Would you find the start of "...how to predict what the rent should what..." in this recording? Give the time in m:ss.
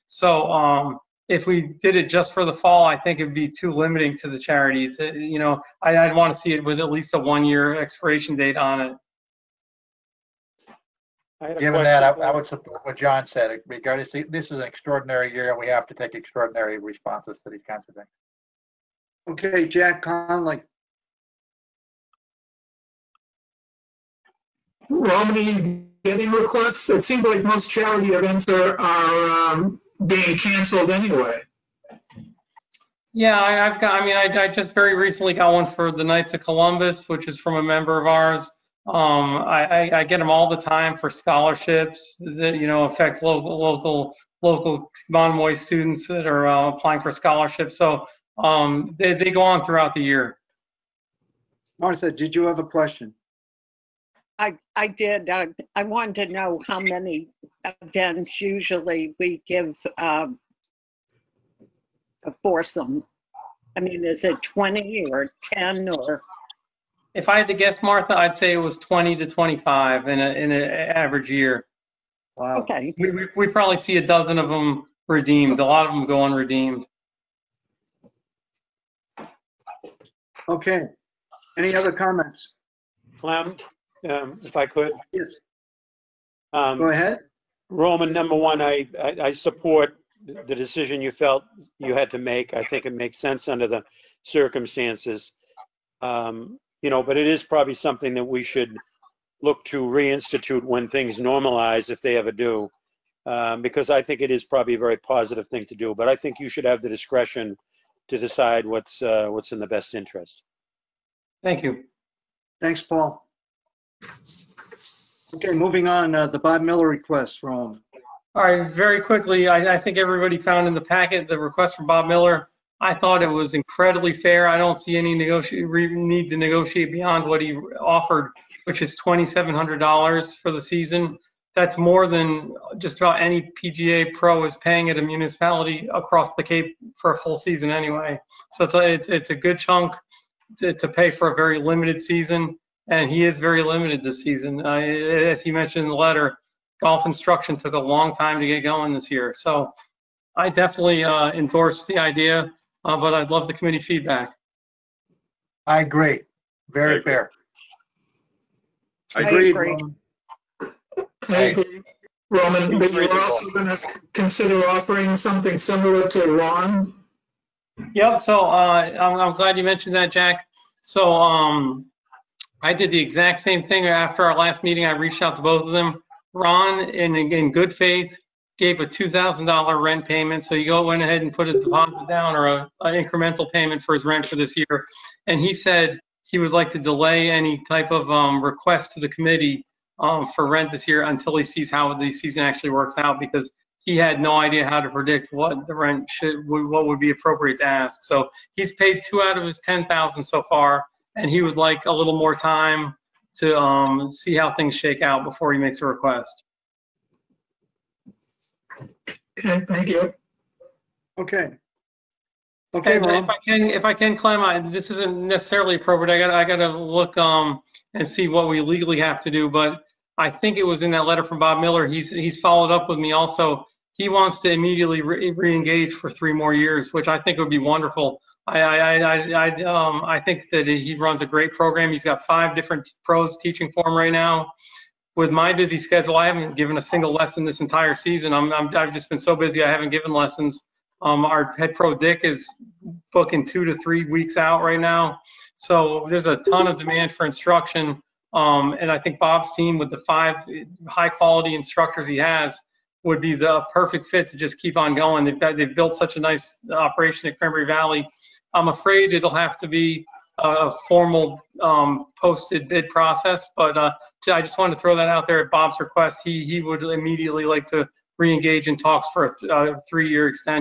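3:14.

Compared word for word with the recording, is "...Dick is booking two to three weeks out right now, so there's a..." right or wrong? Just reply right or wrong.
right.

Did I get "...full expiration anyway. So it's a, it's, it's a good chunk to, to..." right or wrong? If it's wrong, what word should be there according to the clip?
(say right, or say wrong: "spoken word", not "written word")
wrong: "season", not "expiration".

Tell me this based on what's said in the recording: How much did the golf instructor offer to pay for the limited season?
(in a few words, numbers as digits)
$2,700.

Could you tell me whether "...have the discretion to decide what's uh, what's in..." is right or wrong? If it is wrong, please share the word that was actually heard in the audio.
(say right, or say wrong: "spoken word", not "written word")
right.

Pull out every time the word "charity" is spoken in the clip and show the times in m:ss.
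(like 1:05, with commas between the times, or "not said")
0:04, 0:27.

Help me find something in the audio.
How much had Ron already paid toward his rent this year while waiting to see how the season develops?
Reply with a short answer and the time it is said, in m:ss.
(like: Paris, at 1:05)
$2,000, at 2:58.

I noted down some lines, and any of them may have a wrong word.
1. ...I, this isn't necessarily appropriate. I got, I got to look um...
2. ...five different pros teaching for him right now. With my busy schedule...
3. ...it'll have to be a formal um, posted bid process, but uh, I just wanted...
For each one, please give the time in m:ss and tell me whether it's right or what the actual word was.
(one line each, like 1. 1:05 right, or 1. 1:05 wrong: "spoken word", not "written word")
1. 3:34 right
2. 3:52 right
3. 4:19 right.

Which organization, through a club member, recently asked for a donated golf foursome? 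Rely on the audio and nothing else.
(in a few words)
Knights of Columbus.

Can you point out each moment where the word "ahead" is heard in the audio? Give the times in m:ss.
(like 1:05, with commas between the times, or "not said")
1:26, 3:01.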